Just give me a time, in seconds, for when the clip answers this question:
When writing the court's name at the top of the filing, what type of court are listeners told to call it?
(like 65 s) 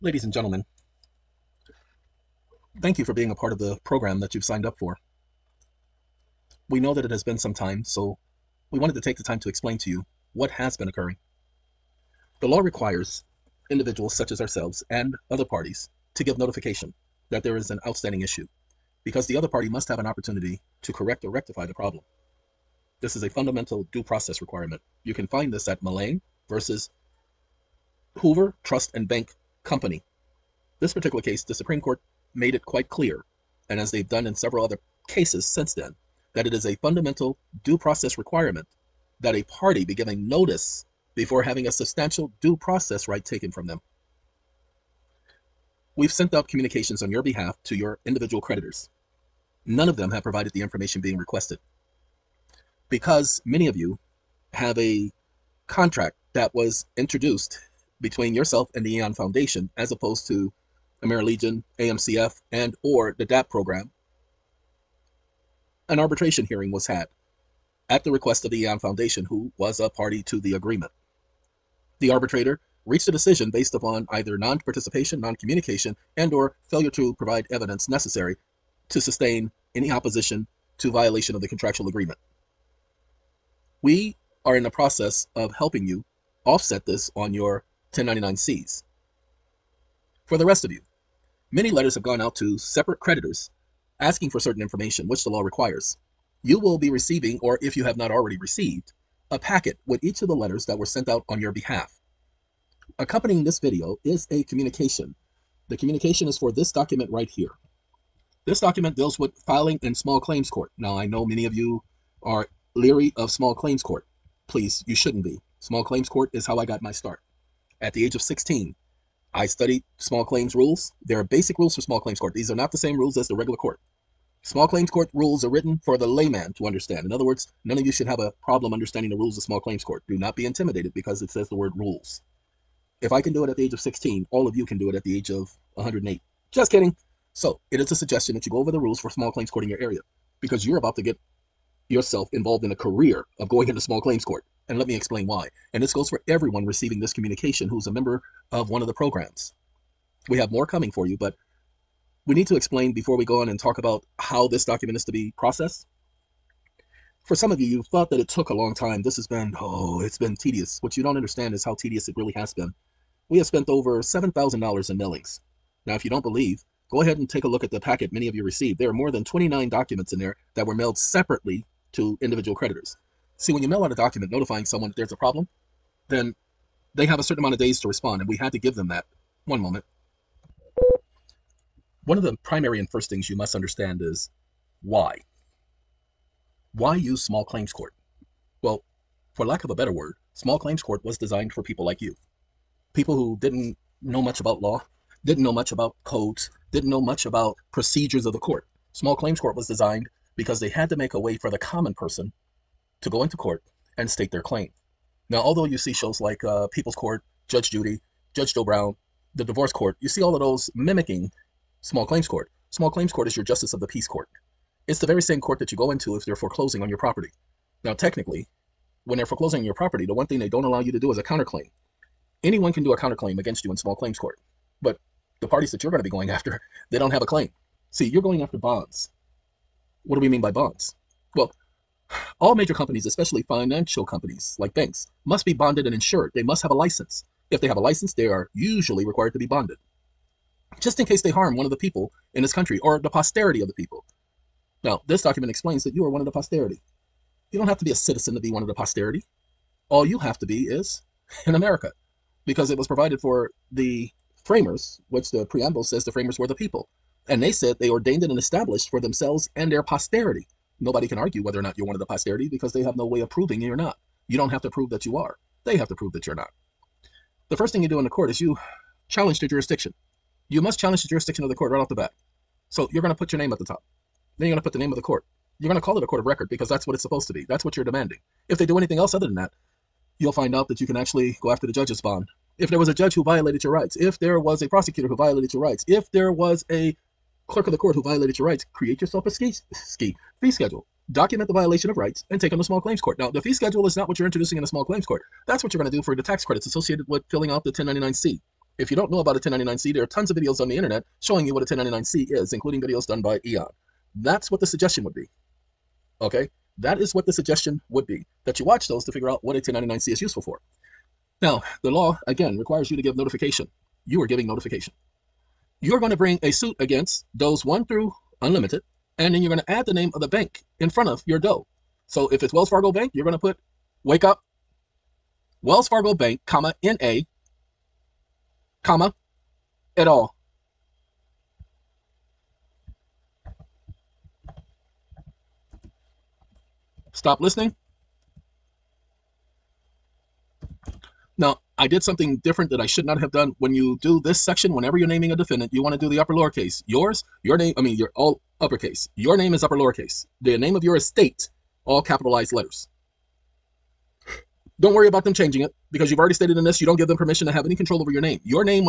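276 s.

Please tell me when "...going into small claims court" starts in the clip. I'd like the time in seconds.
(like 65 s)
143 s.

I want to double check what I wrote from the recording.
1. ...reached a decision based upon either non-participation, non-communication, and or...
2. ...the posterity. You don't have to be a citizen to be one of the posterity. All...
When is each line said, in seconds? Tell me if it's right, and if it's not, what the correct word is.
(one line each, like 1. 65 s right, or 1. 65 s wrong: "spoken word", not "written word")
1. 72 s right
2. 246 s right.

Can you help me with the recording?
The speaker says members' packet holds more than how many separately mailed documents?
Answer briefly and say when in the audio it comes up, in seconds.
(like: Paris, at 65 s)
29, at 169 s.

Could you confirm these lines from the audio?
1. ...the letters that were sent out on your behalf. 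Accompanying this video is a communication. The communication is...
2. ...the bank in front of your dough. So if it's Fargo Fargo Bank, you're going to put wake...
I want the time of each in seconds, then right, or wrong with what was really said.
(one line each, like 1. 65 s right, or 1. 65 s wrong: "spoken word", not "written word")
1. 100 s right
2. 320 s wrong: "Wells", not "Fargo".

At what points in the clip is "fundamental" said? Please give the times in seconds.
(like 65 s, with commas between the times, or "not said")
23 s, 36 s.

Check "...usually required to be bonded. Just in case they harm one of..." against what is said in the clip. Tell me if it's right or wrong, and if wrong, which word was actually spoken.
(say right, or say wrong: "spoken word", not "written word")
right.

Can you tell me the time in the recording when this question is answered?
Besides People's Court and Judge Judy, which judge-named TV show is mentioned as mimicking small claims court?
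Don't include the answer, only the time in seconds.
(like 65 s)
208 s.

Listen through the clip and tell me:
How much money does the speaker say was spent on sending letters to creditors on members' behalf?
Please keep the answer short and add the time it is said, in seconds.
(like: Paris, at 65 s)
$7,000, at 164 s.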